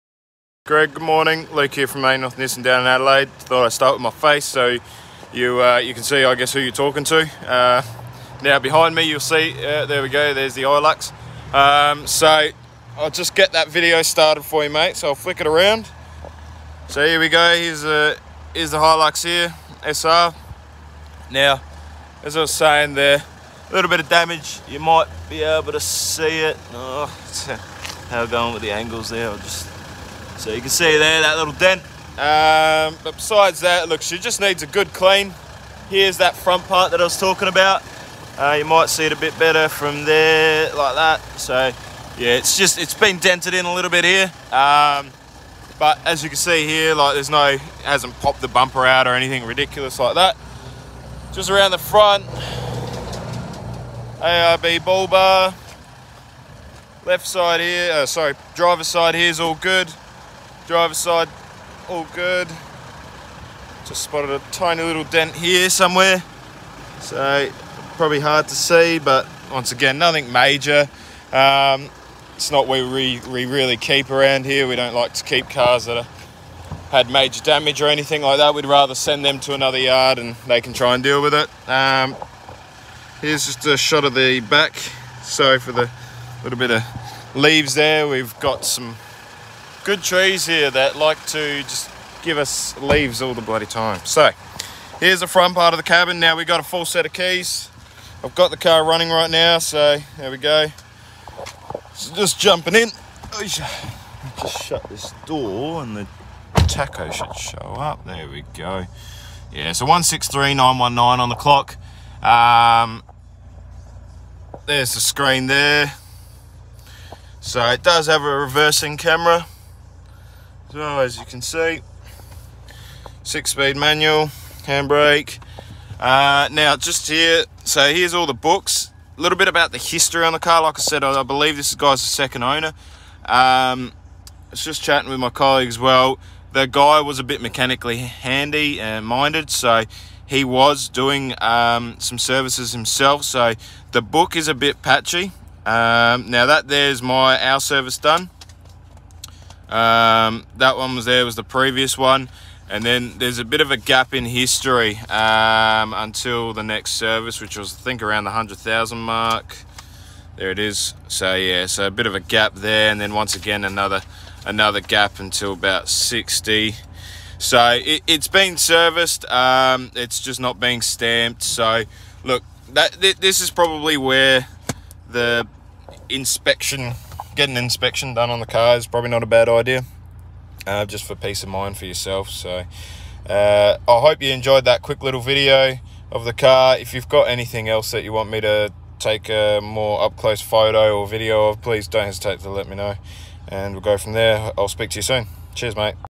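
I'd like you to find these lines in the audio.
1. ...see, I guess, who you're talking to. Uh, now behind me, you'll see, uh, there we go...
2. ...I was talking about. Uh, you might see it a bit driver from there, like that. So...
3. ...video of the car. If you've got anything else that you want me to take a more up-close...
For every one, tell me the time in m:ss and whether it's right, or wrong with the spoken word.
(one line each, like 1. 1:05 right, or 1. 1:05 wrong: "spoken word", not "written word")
1. 0:06 right
2. 0:36 wrong: "better", not "driver"
3. 3:05 right.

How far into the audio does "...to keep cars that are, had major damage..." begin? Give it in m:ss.
1:15.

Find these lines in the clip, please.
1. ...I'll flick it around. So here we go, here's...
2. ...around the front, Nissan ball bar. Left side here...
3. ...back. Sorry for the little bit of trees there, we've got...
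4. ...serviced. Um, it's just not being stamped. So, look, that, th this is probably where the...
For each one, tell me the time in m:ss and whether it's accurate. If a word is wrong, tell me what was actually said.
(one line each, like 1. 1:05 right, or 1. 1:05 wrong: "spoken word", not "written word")
1. 0:15 right
2. 0:51 wrong: "ARB", not "Nissan"
3. 1:24 wrong: "leaves", not "trees"
4. 2:48 right.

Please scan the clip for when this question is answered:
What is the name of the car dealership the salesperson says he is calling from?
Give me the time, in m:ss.
0:02.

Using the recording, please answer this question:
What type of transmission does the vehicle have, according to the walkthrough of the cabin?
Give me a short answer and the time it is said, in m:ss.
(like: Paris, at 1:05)
Six-speed manual, at 2:03.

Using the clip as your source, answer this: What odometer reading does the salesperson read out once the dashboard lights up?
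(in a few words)
163919.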